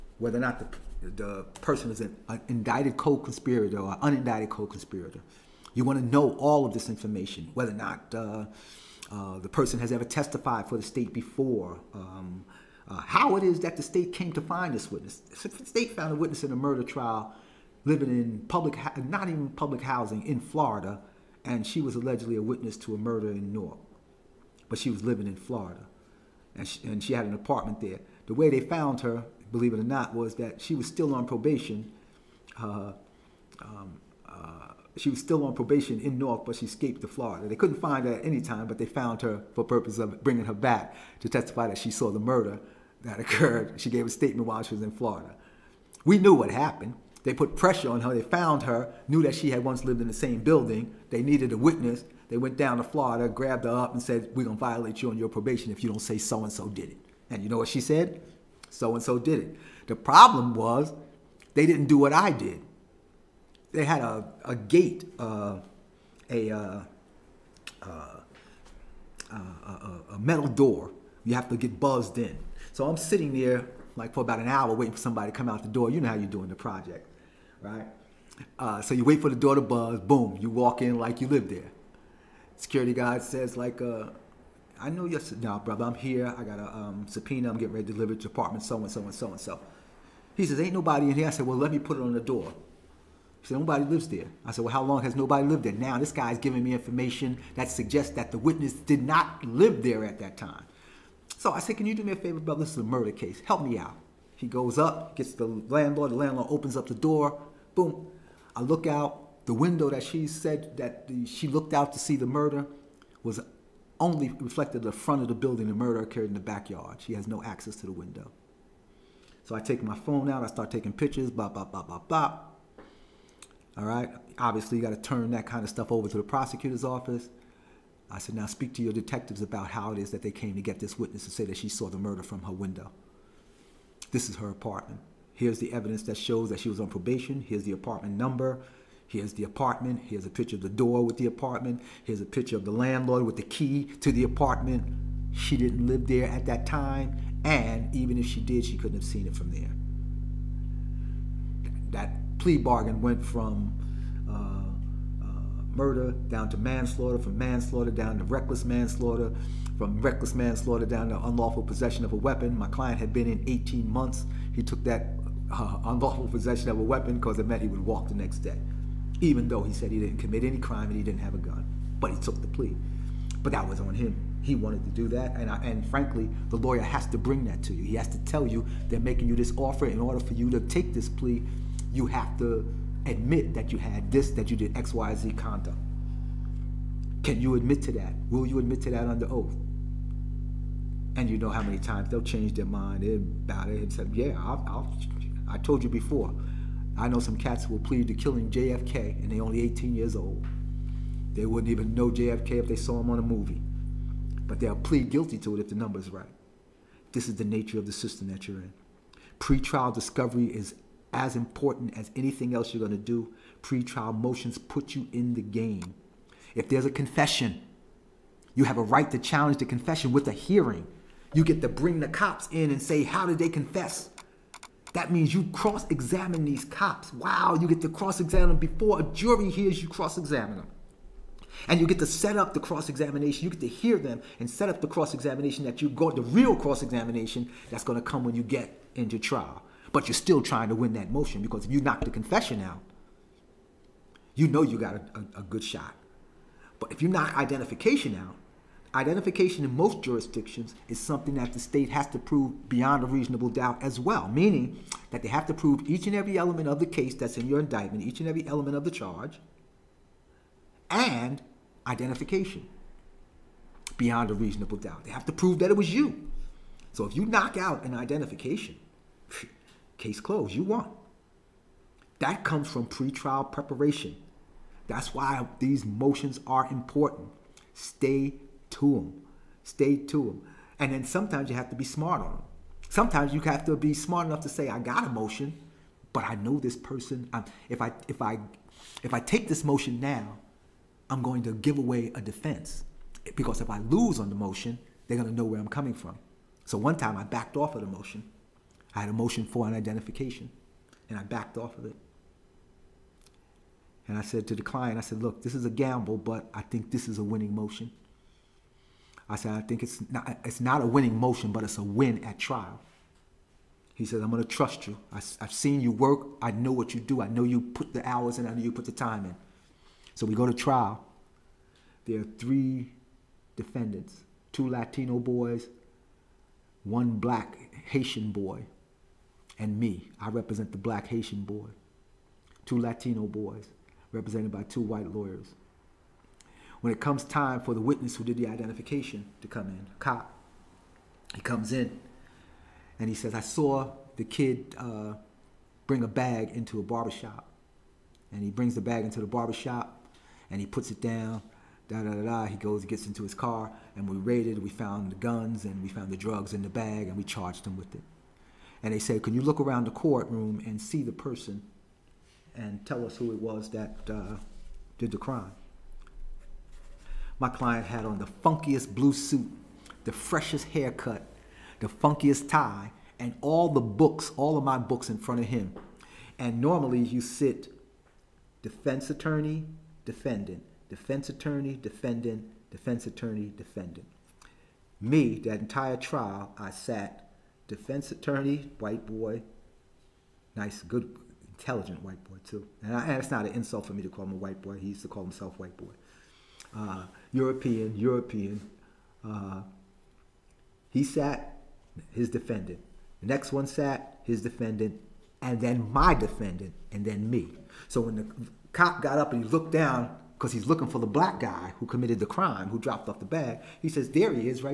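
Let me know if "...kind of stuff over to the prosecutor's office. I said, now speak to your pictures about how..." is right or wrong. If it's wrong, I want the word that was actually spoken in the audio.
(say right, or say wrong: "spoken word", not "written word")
wrong: "detectives", not "pictures".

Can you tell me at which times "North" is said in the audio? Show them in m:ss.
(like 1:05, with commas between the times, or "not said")
0:36.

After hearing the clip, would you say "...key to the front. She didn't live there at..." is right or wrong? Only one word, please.
wrong.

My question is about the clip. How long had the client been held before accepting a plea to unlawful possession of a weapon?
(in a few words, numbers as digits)
18 months.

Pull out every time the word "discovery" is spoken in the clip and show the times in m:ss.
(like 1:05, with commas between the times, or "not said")
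3:29.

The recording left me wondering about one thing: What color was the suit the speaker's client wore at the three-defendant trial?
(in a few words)
blue.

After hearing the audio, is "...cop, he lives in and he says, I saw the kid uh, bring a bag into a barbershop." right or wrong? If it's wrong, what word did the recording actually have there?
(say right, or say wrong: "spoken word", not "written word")
wrong: "comes", not "lives".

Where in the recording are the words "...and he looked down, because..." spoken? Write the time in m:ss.
6:49.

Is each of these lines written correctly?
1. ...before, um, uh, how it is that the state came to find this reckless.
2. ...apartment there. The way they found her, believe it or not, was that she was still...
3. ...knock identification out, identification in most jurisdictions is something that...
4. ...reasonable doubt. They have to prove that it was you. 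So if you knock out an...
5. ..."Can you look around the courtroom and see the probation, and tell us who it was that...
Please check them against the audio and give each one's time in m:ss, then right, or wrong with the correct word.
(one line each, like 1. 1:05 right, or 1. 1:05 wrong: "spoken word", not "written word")
1. 0:11 wrong: "witness", not "reckless"
2. 0:27 right
3. 4:07 right
4. 4:24 right
5. 5:59 wrong: "person", not "probation".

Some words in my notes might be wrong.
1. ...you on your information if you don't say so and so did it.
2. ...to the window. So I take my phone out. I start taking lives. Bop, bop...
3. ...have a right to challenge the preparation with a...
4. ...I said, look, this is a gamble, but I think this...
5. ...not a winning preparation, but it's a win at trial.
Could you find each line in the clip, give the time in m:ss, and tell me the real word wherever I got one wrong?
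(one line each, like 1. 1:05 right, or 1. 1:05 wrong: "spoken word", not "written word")
1. 0:55 wrong: "probation", not "information"
2. 1:57 wrong: "pictures", not "lives"
3. 3:38 wrong: "confession", not "preparation"
4. 5:04 right
5. 5:10 wrong: "motion", not "preparation".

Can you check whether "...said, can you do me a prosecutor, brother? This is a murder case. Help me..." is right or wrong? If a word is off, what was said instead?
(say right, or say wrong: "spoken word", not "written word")
wrong: "favor", not "prosecutor".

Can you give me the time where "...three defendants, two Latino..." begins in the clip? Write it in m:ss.
5:22.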